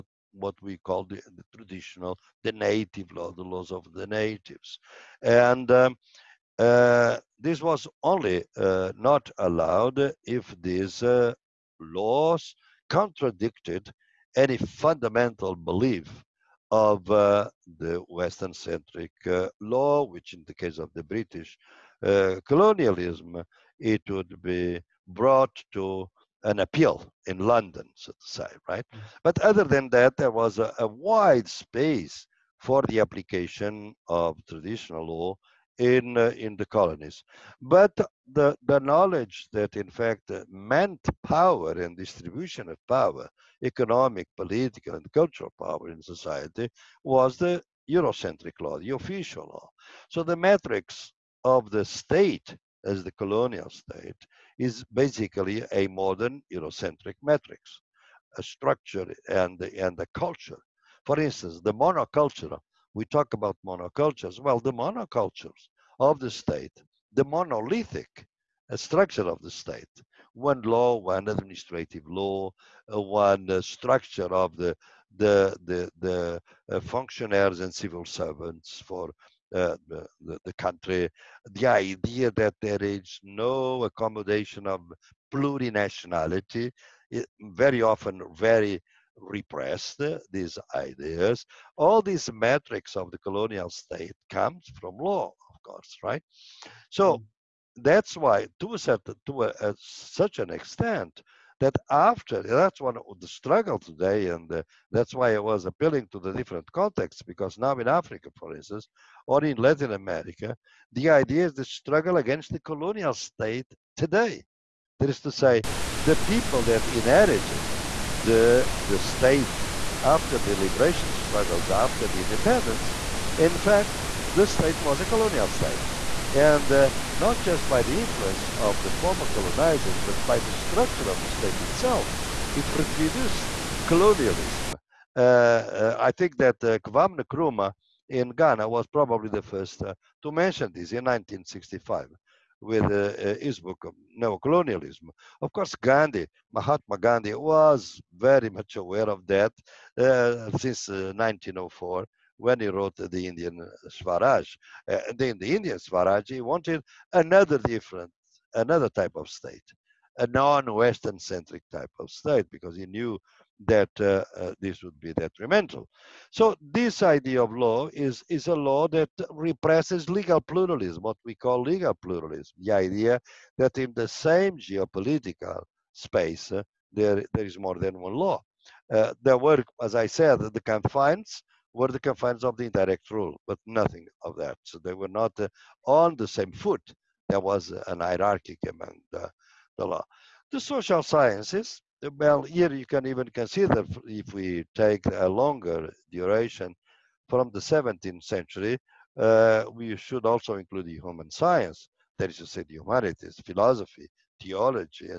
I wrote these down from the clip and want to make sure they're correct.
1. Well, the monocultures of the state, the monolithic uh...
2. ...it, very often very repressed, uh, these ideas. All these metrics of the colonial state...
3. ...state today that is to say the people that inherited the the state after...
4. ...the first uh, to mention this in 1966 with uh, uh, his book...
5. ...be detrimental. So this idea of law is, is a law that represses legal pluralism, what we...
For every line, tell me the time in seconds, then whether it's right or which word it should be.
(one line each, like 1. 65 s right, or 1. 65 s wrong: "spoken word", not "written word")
1. 64 s right
2. 87 s right
3. 113 s right
4. 139 s wrong: "1965", not "1966"
5. 165 s right.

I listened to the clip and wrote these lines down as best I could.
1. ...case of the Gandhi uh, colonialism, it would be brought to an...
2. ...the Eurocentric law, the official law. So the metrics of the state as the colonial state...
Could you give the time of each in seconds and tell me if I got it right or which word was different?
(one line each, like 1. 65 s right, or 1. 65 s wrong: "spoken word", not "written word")
1. 20 s wrong: "British", not "Gandhi"
2. 47 s right.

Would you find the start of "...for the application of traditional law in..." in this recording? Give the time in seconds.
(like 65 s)
32 s.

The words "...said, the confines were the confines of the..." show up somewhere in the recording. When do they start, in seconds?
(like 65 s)
180 s.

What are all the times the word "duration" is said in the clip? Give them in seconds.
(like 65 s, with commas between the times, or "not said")
196 s.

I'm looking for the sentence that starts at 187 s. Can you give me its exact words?
There was an hierarchy among the, the law.